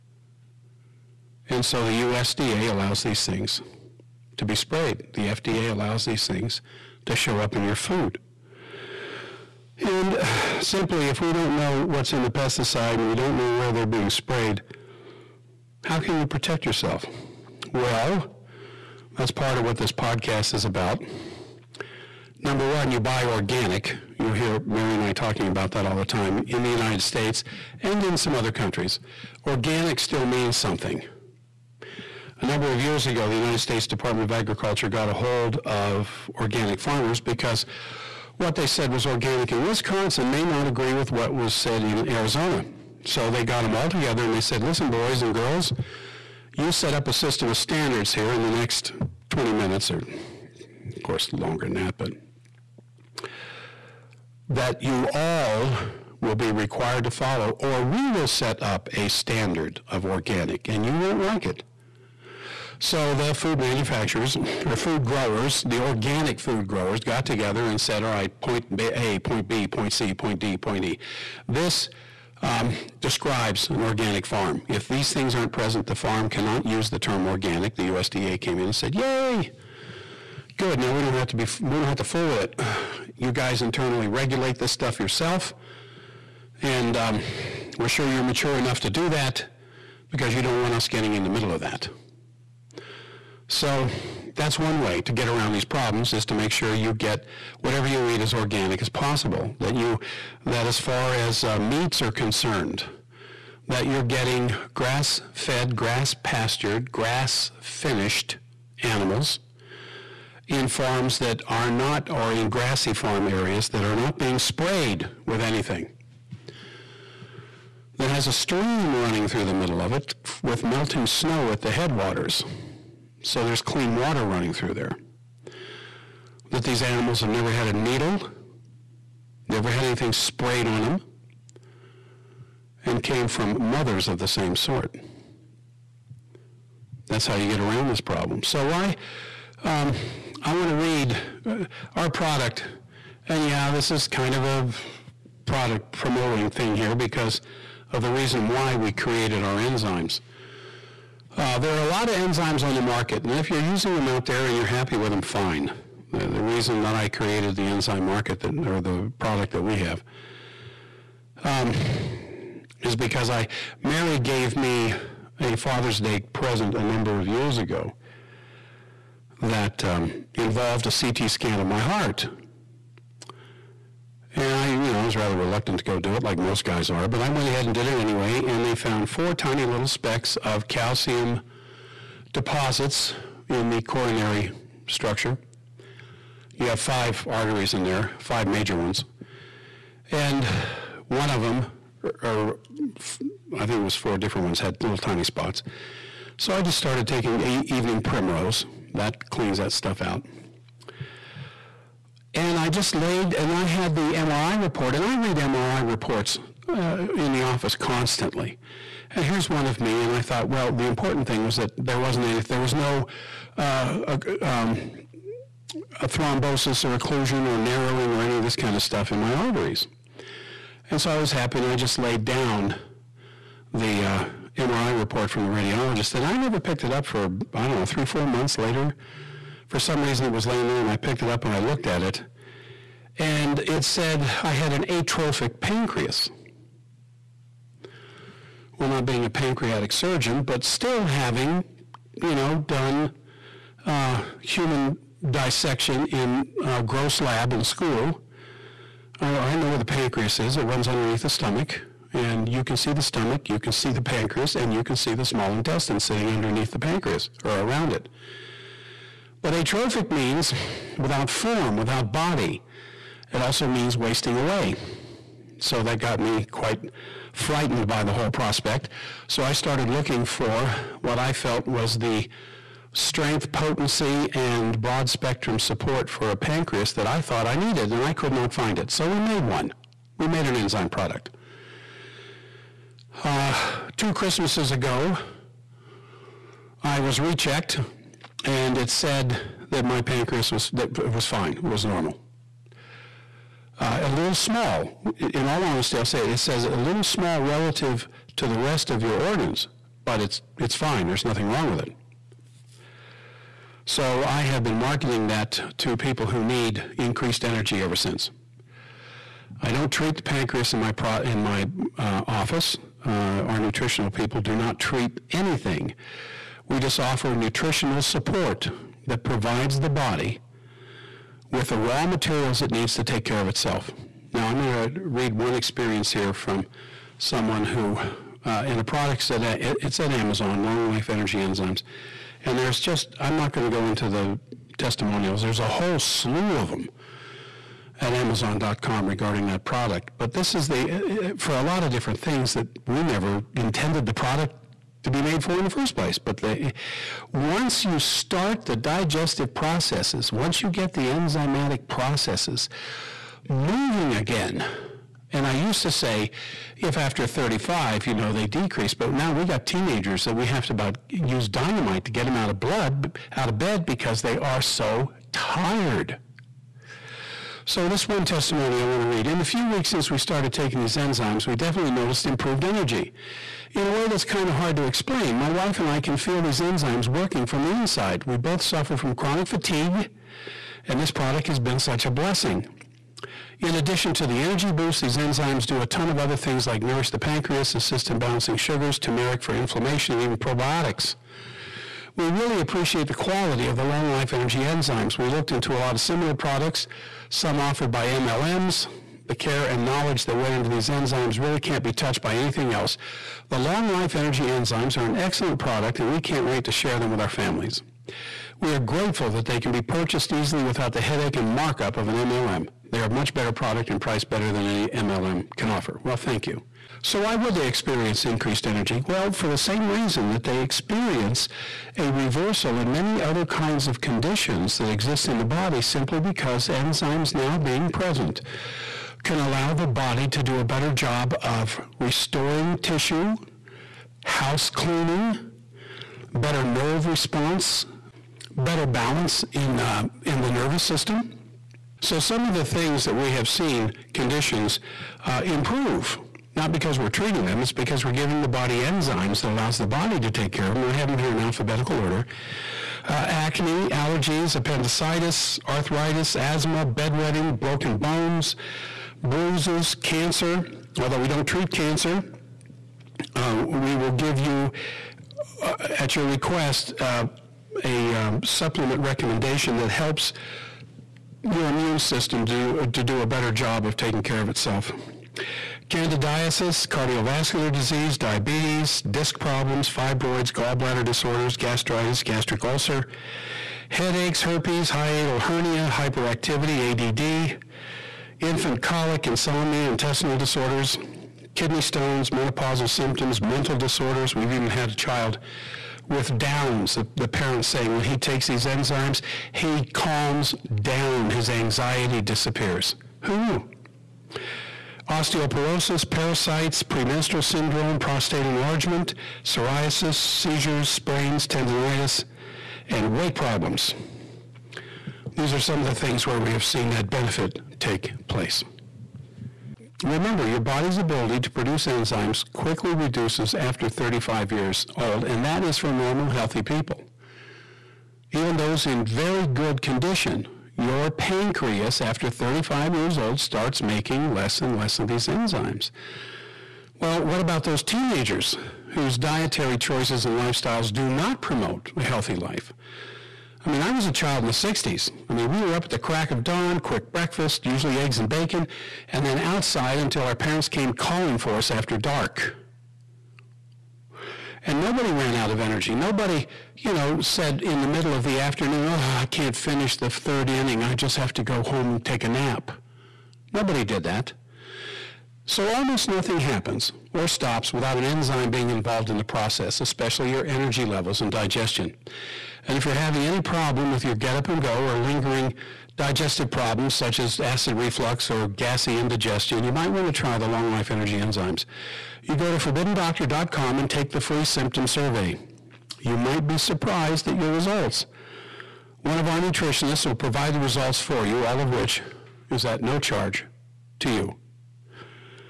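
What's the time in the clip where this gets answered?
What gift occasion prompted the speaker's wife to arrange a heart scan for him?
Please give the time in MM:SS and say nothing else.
02:45.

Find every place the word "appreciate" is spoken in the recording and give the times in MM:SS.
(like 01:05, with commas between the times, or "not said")
06:32.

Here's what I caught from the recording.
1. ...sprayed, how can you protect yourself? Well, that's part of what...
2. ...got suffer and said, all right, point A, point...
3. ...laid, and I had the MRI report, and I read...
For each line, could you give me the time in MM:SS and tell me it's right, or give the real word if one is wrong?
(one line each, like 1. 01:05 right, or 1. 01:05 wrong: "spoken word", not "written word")
1. 00:14 right
2. 01:06 wrong: "together", not "suffer"
3. 03:22 right.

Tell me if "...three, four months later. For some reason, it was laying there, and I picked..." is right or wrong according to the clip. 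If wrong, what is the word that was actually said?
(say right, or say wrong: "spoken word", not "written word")
right.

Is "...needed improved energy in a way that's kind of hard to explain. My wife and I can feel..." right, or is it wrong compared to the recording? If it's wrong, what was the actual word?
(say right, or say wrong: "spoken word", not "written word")
wrong: "noticed", not "needed".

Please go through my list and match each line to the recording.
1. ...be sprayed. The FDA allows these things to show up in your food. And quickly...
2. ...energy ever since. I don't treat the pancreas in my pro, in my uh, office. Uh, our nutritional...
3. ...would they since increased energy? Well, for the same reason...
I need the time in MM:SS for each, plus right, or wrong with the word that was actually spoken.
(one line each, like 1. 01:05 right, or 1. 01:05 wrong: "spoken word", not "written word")
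1. 00:04 wrong: "simply", not "quickly"
2. 05:07 right
3. 06:57 wrong: "experience", not "since".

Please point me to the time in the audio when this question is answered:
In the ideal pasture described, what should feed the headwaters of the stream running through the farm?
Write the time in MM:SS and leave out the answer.
02:00.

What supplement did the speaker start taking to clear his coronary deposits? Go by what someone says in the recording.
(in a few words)
evening primrose.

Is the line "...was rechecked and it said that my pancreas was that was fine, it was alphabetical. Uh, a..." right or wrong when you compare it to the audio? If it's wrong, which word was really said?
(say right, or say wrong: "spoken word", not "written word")
wrong: "normal", not "alphabetical".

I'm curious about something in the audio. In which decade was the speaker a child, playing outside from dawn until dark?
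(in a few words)
the 60s.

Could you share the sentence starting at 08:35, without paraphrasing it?
These are some of the things where we have seen that benefit take place.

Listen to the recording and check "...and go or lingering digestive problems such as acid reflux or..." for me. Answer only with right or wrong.
right.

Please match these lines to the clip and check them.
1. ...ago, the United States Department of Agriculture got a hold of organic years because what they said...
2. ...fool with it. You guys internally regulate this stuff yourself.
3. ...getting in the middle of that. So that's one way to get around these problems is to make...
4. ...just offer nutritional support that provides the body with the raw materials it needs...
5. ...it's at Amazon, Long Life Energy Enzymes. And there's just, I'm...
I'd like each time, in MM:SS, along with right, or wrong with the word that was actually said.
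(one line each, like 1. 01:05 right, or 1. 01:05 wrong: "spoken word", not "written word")
1. 00:33 wrong: "farmers", not "years"
2. 01:22 right
3. 01:30 right
4. 05:16 right
5. 05:29 right.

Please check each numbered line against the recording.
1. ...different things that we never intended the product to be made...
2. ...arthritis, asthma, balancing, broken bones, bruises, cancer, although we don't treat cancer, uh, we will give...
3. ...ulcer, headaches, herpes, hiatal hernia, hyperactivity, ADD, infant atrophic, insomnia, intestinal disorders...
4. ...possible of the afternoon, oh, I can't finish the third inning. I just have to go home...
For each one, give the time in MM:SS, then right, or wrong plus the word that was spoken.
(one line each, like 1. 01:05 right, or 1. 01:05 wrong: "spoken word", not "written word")
1. 05:41 right
2. 07:35 wrong: "bedwetting", not "balancing"
3. 08:02 wrong: "colic", not "atrophic"
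4. 09:17 wrong: "middle", not "possible".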